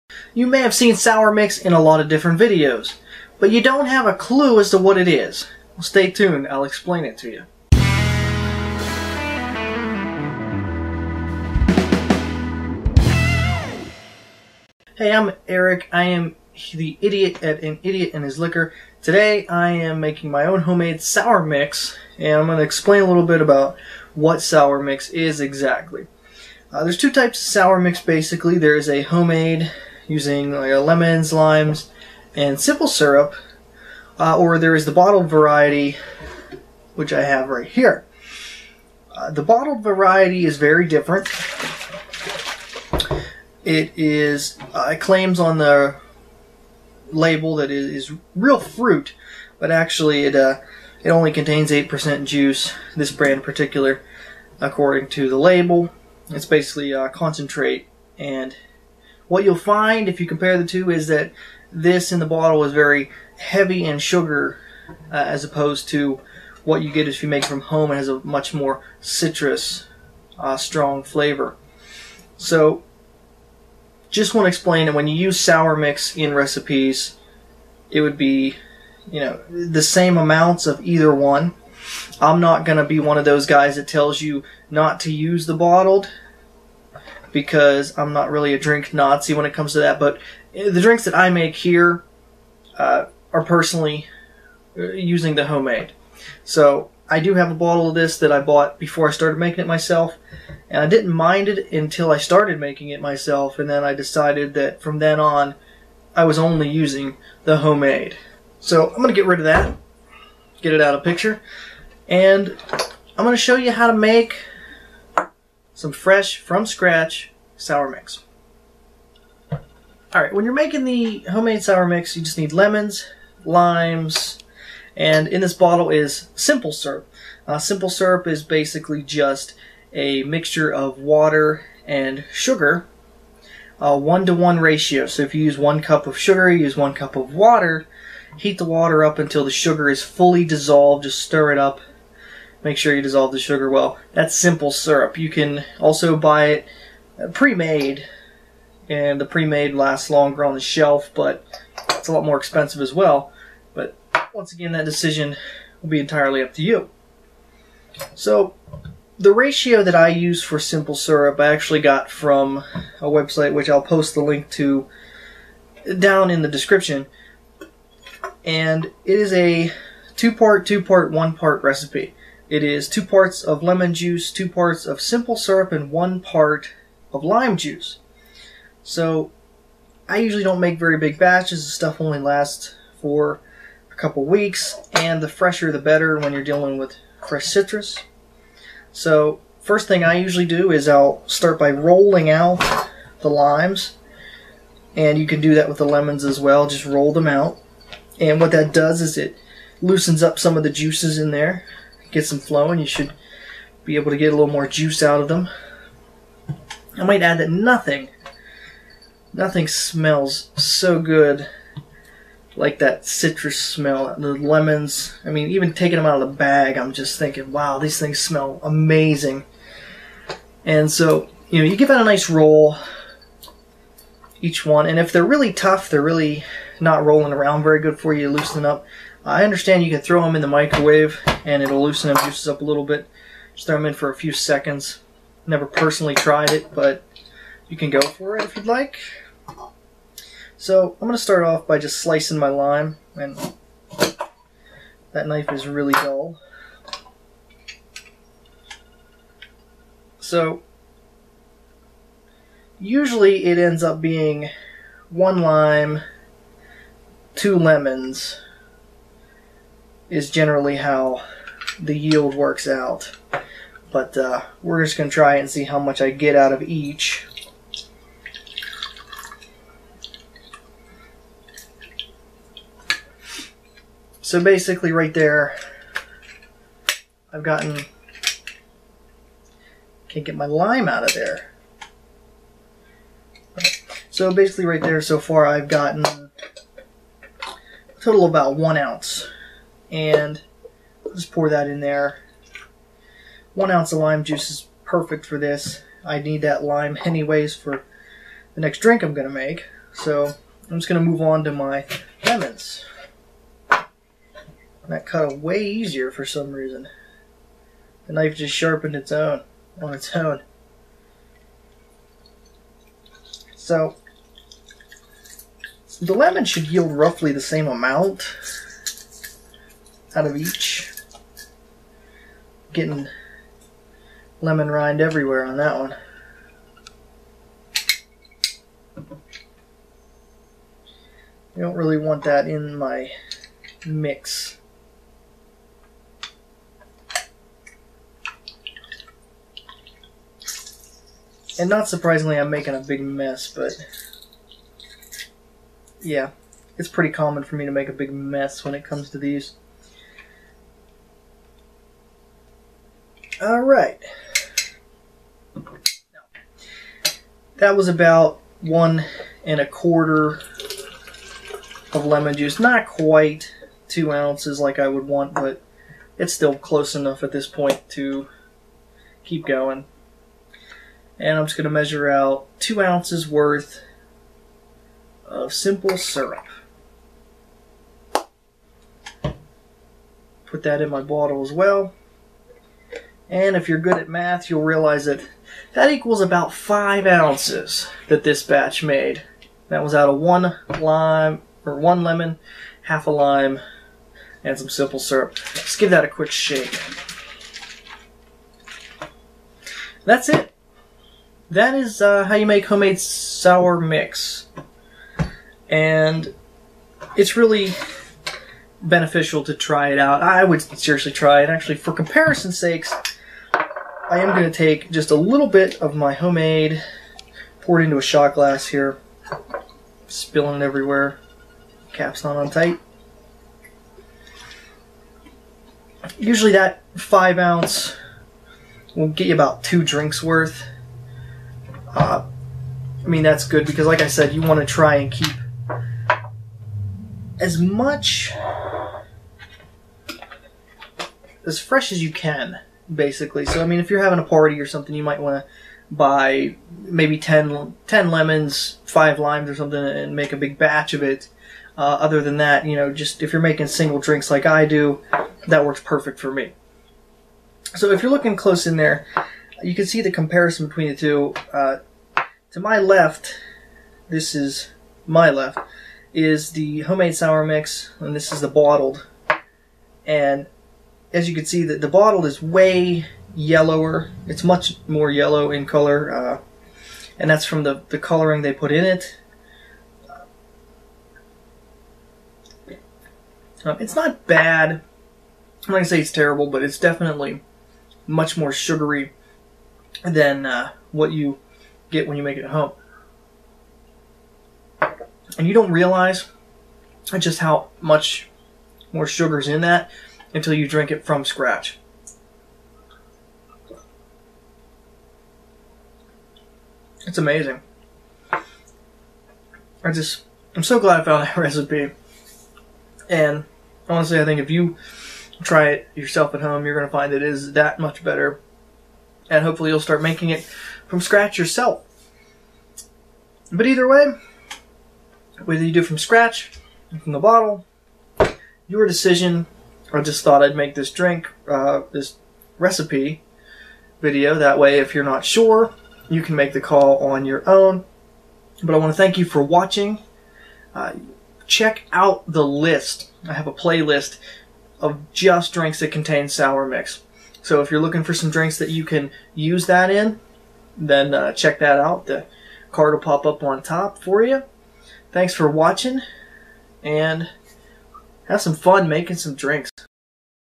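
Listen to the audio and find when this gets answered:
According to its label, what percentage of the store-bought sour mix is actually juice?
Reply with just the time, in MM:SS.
00:51.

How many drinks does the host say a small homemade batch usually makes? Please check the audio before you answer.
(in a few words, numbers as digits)
2.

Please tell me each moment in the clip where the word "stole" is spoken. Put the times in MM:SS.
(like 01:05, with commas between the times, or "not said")
not said.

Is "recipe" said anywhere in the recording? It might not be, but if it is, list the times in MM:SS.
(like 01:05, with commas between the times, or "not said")
01:16, 02:51, 08:31, 08:52.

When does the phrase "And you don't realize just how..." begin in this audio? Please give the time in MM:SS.
08:15.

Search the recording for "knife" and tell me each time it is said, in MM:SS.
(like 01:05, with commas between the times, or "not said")
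04:05, 05:08.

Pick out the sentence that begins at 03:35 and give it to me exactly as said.
I mean, even taking them out of the bag, I'm just thinking, wow, these things smell amazing.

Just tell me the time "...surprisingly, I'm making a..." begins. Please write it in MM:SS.
05:41.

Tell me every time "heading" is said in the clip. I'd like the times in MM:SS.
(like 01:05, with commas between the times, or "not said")
not said.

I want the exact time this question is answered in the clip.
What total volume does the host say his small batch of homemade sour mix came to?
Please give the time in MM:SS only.
06:26.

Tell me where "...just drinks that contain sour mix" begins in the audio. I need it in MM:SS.
09:05.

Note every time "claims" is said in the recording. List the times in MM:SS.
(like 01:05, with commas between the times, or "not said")
00:44.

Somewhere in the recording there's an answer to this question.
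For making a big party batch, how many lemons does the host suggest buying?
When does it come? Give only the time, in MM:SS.
07:27.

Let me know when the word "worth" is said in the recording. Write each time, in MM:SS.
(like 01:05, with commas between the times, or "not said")
06:13, 07:10.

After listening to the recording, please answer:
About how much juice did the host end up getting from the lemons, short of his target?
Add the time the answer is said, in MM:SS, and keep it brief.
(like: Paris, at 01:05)
1.25 ounces, at 05:58.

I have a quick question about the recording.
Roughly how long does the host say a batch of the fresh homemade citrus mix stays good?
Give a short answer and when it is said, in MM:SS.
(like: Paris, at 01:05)
A couple weeks, at 03:03.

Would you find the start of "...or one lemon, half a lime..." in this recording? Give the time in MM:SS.
06:31.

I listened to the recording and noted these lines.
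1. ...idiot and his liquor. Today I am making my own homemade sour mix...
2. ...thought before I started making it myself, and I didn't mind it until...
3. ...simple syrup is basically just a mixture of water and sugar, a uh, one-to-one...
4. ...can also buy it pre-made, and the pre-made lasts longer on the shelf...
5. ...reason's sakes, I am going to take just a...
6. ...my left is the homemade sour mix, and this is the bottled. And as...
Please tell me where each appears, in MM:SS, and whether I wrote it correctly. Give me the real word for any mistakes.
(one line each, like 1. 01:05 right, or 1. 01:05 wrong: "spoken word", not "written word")
1. 00:17 right
2. 01:38 wrong: "bought", not "thought"
3. 02:07 right
4. 02:25 right
5. 06:51 wrong: "comparison", not "reason"
6. 07:45 right.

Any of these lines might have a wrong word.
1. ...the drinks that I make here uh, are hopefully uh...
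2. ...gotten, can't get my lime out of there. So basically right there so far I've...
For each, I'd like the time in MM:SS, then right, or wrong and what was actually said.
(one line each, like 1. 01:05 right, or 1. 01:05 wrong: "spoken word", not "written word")
1. 01:30 wrong: "personally", not "hopefully"
2. 04:37 right.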